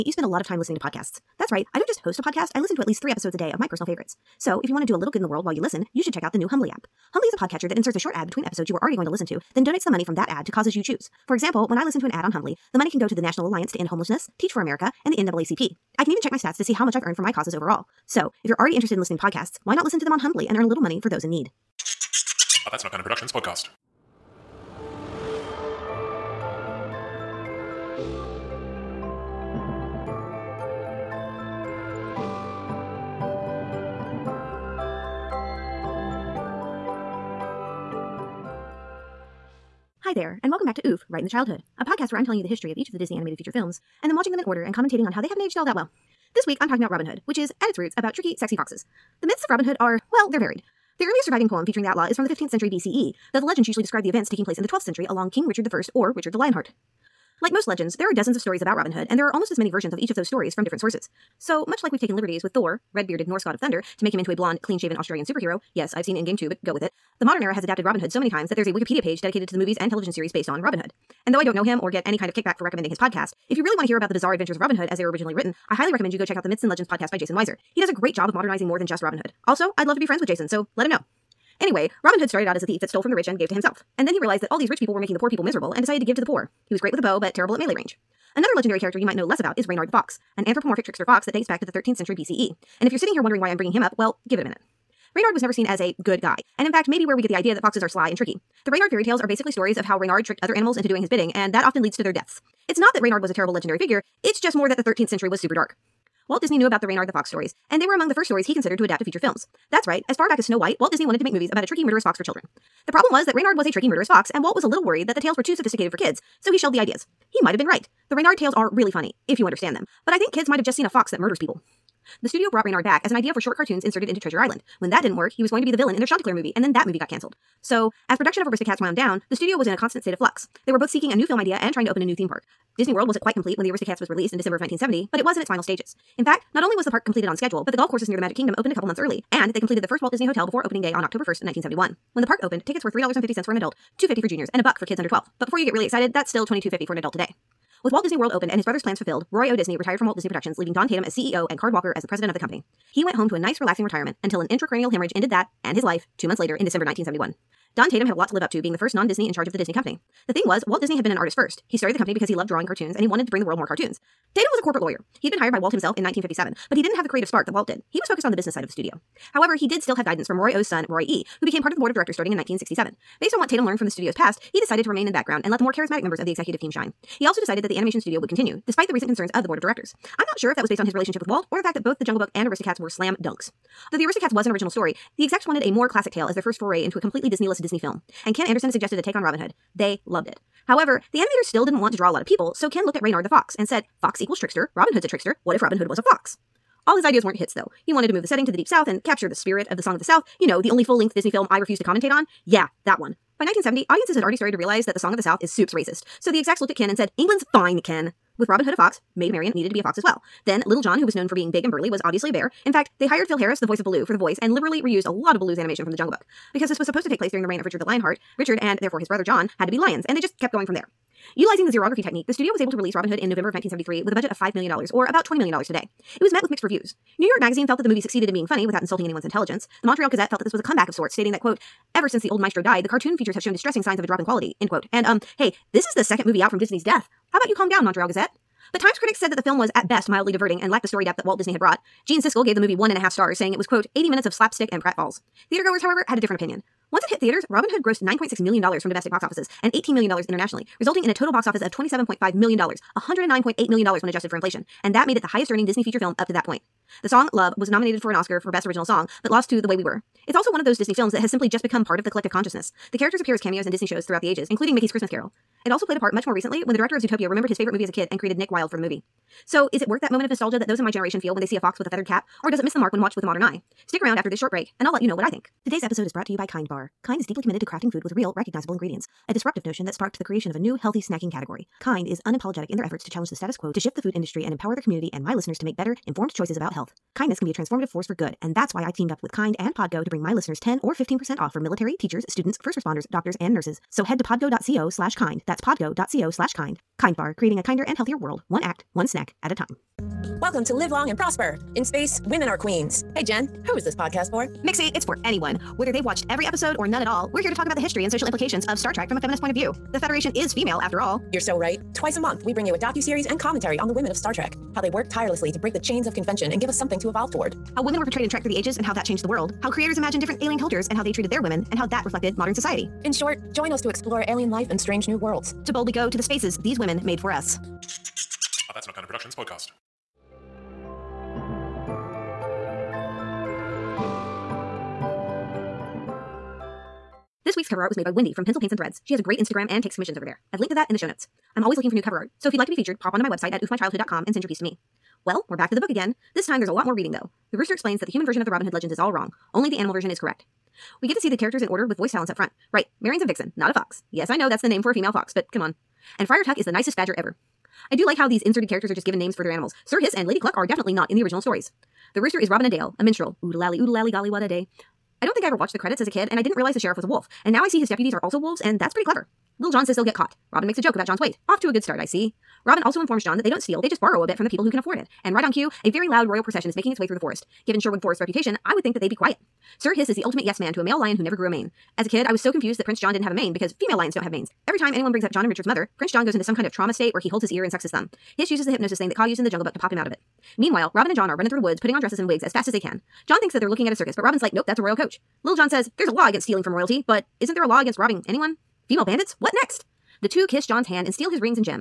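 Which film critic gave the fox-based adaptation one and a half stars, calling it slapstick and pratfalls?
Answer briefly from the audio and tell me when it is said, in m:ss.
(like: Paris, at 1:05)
Gene Siskel, at 4:02.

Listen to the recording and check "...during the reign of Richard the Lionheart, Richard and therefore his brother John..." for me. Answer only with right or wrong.
right.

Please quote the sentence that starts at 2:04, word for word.
When that didn't work, he was going to be the villain in their Chanticleer movie, and then that movie got canceled.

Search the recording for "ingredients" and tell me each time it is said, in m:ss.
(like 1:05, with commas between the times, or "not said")
4:38.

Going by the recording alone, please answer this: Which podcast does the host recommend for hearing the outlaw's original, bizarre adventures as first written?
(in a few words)
Myths and Legends.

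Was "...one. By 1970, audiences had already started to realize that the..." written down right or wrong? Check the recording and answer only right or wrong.
right.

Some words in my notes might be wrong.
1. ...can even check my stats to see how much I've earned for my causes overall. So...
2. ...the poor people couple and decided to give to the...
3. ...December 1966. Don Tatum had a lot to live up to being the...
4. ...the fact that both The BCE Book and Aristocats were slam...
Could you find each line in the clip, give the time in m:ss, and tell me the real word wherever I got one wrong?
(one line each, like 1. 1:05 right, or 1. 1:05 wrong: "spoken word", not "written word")
1. 0:16 right
2. 1:25 wrong: "miserable", not "couple"
3. 2:36 wrong: "1971", not "1966"
4. 3:01 wrong: "Jungle", not "BCE".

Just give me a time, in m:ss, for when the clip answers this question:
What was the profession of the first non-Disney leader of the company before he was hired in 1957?
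2:44.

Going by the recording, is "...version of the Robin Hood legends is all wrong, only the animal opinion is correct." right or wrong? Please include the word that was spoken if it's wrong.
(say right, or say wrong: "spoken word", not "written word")
wrong: "version", not "opinion".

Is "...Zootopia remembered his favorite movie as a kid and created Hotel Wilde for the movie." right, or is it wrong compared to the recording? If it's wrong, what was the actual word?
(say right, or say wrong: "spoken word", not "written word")
wrong: "Nick", not "Hotel".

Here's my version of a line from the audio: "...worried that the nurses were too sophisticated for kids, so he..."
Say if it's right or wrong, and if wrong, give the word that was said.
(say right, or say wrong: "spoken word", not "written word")
wrong: "tales", not "nurses".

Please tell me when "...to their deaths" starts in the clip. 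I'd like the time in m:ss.
1:41.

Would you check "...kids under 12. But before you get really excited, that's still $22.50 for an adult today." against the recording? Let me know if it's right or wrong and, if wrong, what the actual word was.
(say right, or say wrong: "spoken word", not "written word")
right.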